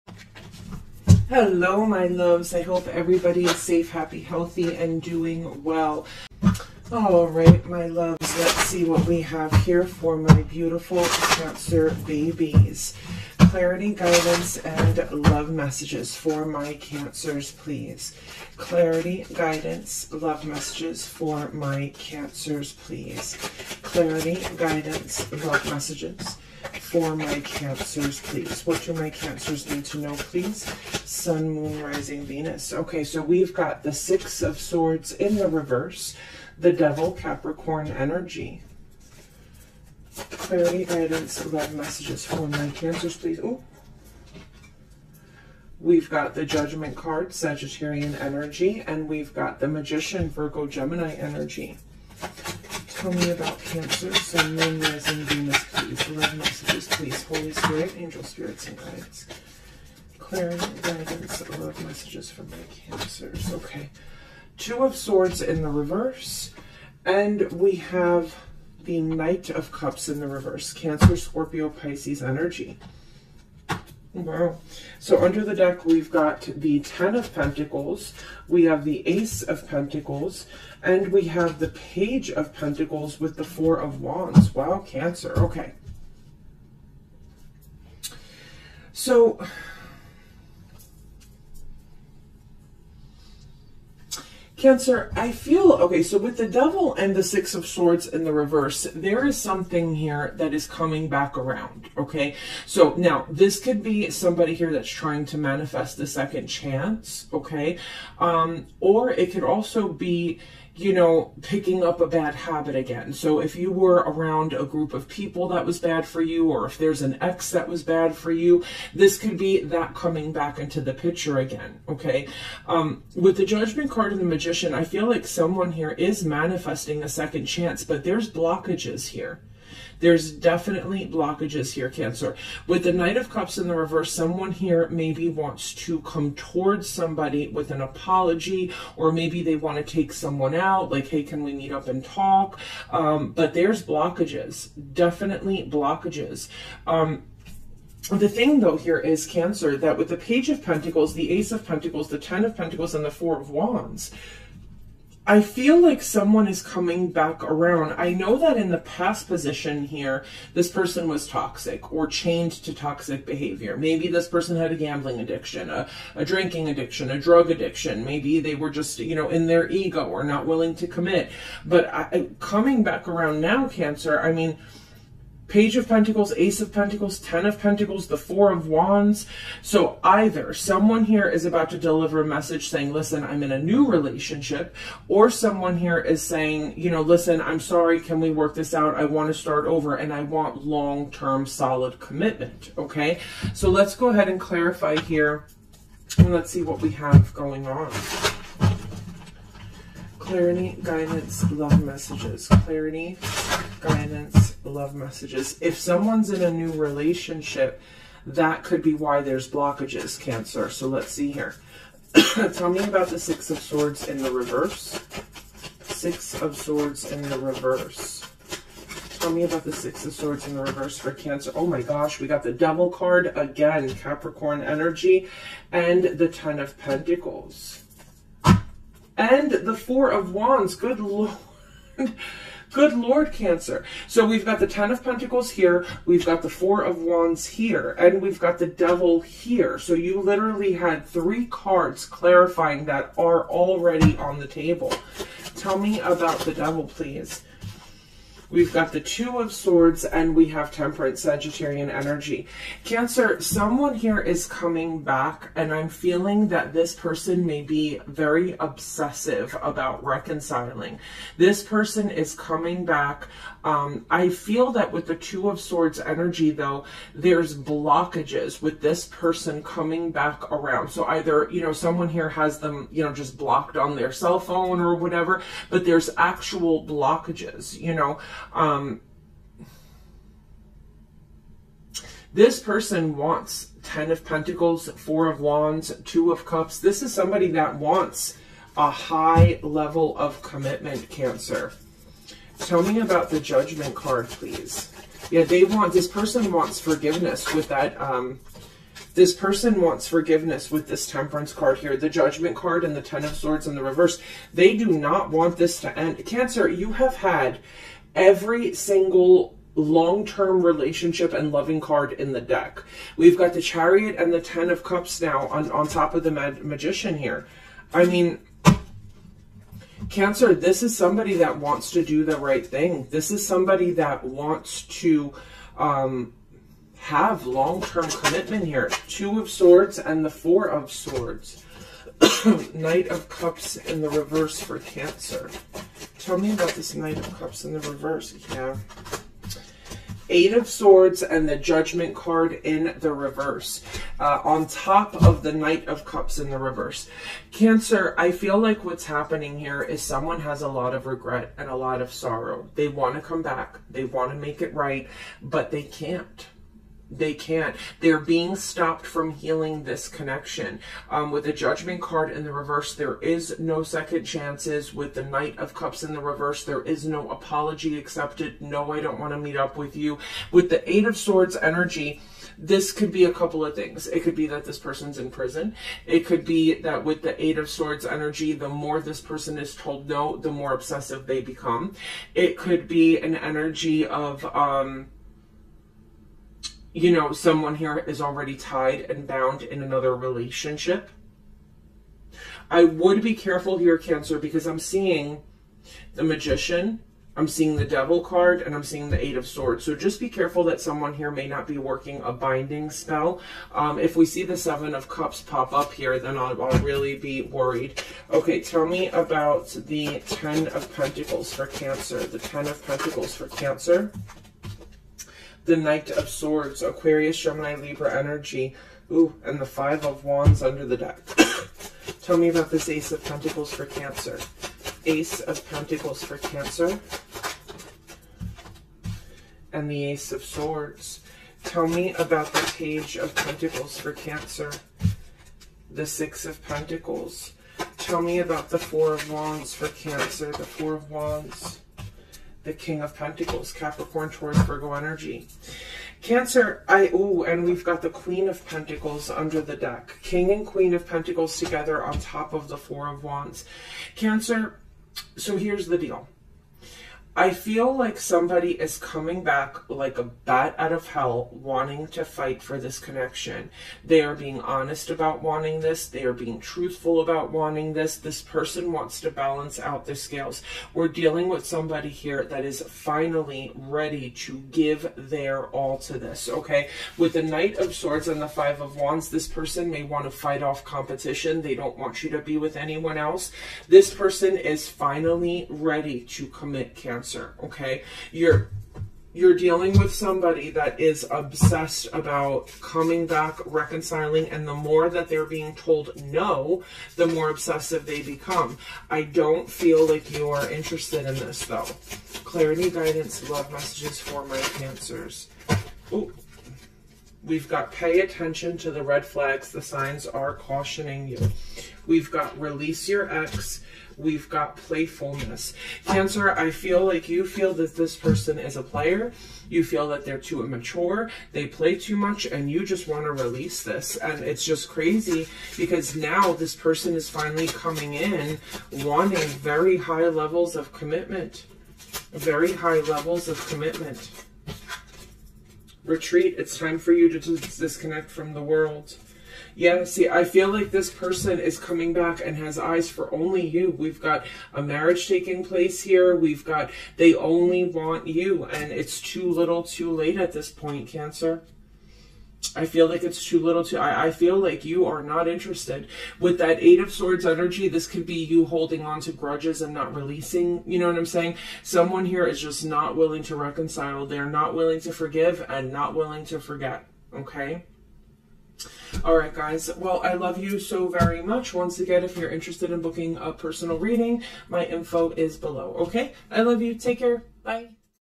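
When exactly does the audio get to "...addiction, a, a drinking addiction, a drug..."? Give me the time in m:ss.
2:45.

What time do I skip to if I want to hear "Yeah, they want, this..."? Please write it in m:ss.
4:55.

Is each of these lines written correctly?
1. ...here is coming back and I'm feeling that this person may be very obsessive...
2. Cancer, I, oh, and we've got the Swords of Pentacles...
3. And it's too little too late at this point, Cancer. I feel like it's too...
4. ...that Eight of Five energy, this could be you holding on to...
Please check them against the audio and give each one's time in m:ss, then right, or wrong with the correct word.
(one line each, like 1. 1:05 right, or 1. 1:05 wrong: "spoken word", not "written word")
1. 4:13 right
2. 7:26 wrong: "Queen", not "Swords"
3. 9:08 right
4. 9:16 wrong: "Swords", not "Five".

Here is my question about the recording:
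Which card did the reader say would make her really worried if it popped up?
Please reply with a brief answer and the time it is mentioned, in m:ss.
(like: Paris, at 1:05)
Seven of Cups, at 6:44.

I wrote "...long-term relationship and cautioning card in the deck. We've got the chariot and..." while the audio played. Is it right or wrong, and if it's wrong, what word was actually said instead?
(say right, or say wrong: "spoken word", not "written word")
wrong: "loving", not "cautioning".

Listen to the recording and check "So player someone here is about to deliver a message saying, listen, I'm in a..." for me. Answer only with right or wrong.
wrong.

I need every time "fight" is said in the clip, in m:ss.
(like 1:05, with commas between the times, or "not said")
7:42, 8:00.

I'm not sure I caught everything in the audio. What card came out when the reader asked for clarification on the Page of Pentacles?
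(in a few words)
Six of Pentacles.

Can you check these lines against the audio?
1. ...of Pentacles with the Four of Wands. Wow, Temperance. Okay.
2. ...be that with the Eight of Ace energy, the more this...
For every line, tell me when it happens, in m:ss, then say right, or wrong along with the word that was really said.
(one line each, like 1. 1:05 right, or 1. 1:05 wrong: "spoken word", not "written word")
1. 1:22 wrong: "Cancer", not "Temperance"
2. 6:16 wrong: "Swords", not "Ace".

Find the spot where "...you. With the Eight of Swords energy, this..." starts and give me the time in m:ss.
6:09.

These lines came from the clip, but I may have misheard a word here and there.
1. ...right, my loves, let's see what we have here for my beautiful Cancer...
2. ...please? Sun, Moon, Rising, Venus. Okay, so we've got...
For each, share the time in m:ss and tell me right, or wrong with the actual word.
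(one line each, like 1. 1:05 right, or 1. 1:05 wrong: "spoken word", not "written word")
1. 0:07 right
2. 0:30 right.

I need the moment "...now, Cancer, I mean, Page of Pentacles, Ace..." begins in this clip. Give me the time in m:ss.
2:53.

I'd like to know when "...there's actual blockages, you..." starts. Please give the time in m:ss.
4:35.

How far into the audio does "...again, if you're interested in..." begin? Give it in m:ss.
9:31.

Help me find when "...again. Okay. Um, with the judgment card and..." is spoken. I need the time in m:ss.
2:01.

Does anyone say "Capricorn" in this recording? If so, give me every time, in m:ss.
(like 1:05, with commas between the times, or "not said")
0:37, 3:43, 7:23.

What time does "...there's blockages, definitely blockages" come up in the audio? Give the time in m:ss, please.
2:23.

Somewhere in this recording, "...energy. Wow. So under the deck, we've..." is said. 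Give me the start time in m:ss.
1:12.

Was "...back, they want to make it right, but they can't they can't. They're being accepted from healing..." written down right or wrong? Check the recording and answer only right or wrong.
wrong.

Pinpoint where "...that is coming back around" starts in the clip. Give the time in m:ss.
1:40.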